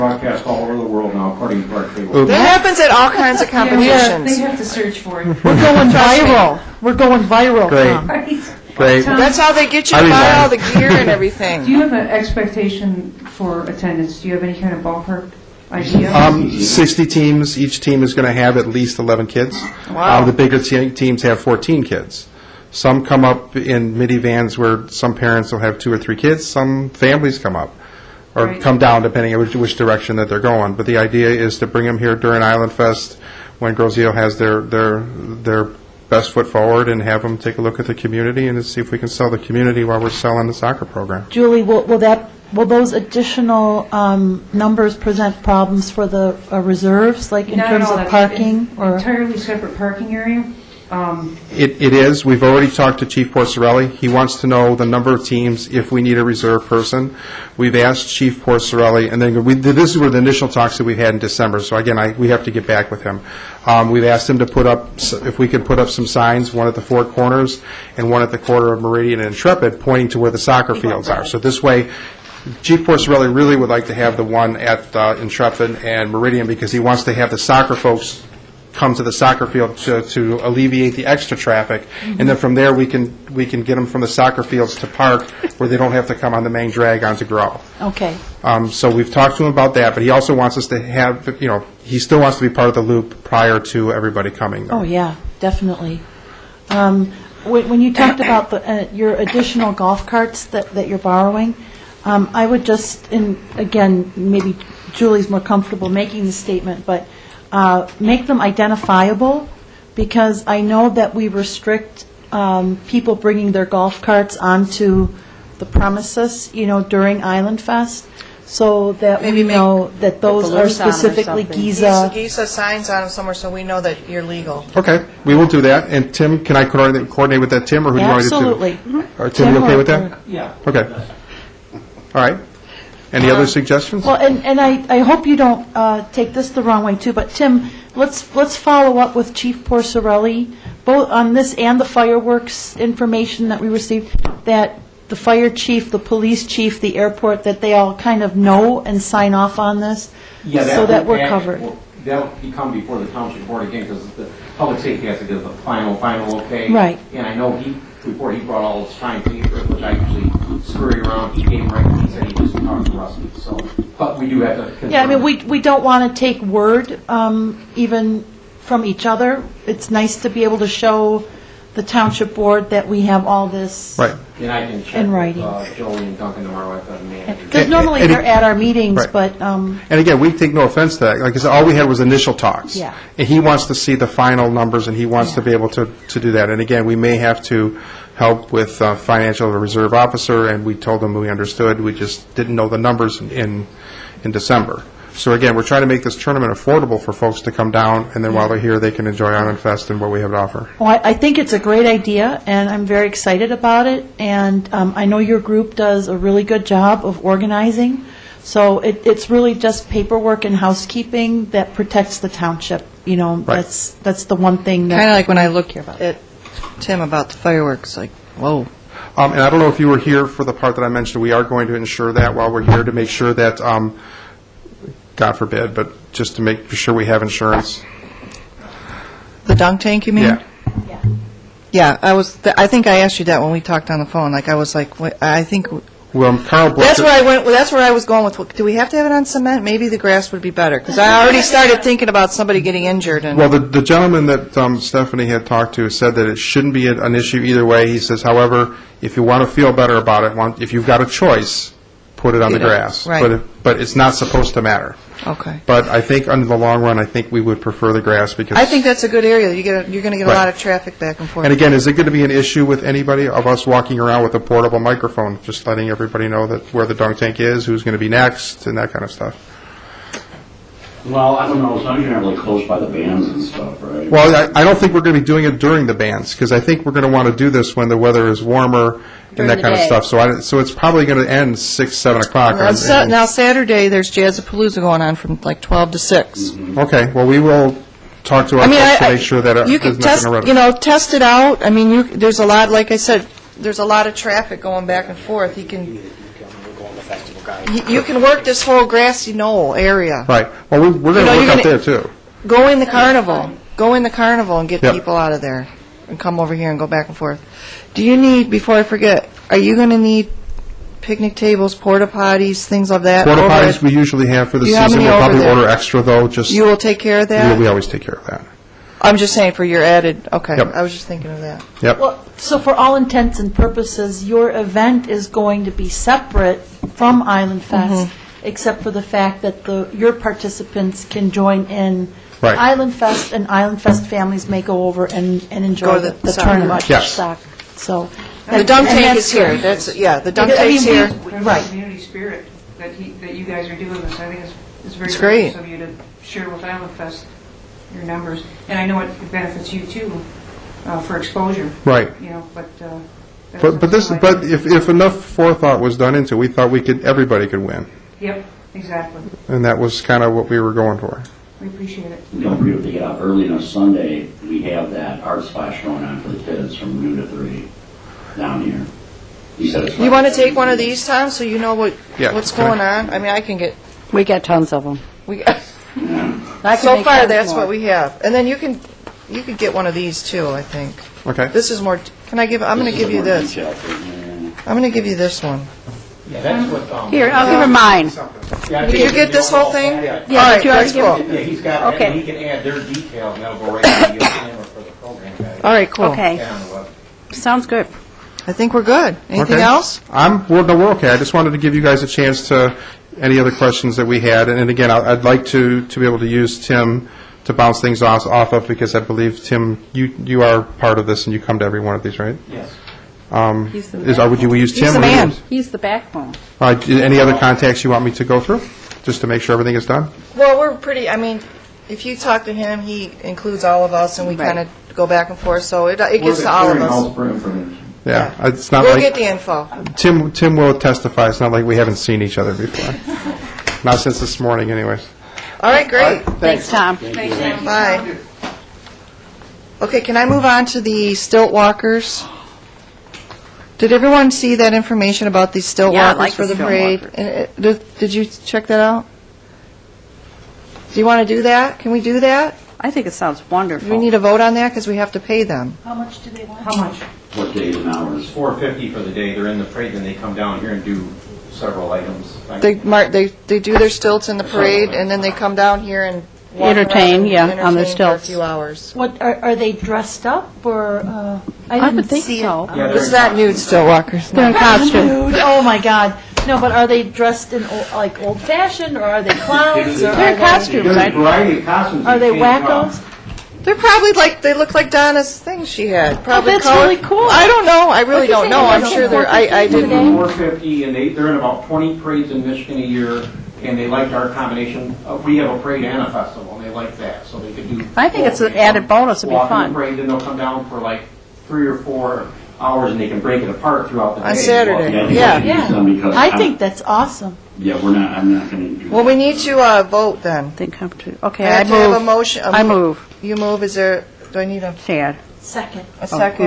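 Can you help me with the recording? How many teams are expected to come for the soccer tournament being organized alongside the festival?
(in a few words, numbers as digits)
60.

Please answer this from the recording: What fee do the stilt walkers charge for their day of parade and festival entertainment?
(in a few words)
$450.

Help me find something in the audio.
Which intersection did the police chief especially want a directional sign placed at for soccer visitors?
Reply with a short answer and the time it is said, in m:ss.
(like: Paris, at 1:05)
Intrepid and Meridian, at 1:15.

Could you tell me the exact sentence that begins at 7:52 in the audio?
Yeah, This is that nude still walkers.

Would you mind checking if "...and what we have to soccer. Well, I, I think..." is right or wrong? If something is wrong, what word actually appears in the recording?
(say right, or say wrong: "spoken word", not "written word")
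wrong: "offer", not "soccer".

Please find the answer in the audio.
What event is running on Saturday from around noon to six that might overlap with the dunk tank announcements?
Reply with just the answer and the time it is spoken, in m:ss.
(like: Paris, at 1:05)
Jazzapalooza, at 4:44.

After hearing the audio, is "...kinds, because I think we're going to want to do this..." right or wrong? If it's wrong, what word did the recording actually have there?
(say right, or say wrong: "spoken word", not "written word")
wrong: "bands", not "kinds".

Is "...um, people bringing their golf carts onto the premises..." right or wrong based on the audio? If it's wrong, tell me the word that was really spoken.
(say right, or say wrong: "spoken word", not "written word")
right.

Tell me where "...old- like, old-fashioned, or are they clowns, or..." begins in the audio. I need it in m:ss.
7:57.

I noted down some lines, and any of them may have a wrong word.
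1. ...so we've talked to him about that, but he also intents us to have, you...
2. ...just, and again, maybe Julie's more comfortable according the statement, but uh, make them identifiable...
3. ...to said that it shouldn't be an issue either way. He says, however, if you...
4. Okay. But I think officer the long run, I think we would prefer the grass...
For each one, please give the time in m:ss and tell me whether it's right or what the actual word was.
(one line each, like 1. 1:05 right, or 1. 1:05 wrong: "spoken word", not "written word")
1. 1:28 wrong: "wants", not "intents"
2. 1:42 wrong: "making", not "according"
3. 4:05 right
4. 4:15 wrong: "under", not "officer".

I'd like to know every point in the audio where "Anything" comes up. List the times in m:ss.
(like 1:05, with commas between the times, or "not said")
6:39.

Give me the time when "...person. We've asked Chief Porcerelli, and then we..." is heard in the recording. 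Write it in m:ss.
0:56.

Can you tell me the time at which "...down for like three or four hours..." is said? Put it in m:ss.
8:20.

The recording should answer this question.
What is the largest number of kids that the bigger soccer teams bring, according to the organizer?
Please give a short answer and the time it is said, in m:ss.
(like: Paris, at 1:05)
14, at 0:21.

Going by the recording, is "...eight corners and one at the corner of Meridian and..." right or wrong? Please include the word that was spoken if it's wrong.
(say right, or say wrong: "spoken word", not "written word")
wrong: "four", not "eight".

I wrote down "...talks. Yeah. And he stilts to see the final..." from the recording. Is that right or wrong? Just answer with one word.
wrong.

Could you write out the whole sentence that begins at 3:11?
We just didn't know the numbers in in December.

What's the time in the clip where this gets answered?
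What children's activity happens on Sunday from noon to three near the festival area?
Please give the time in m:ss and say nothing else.
6:05.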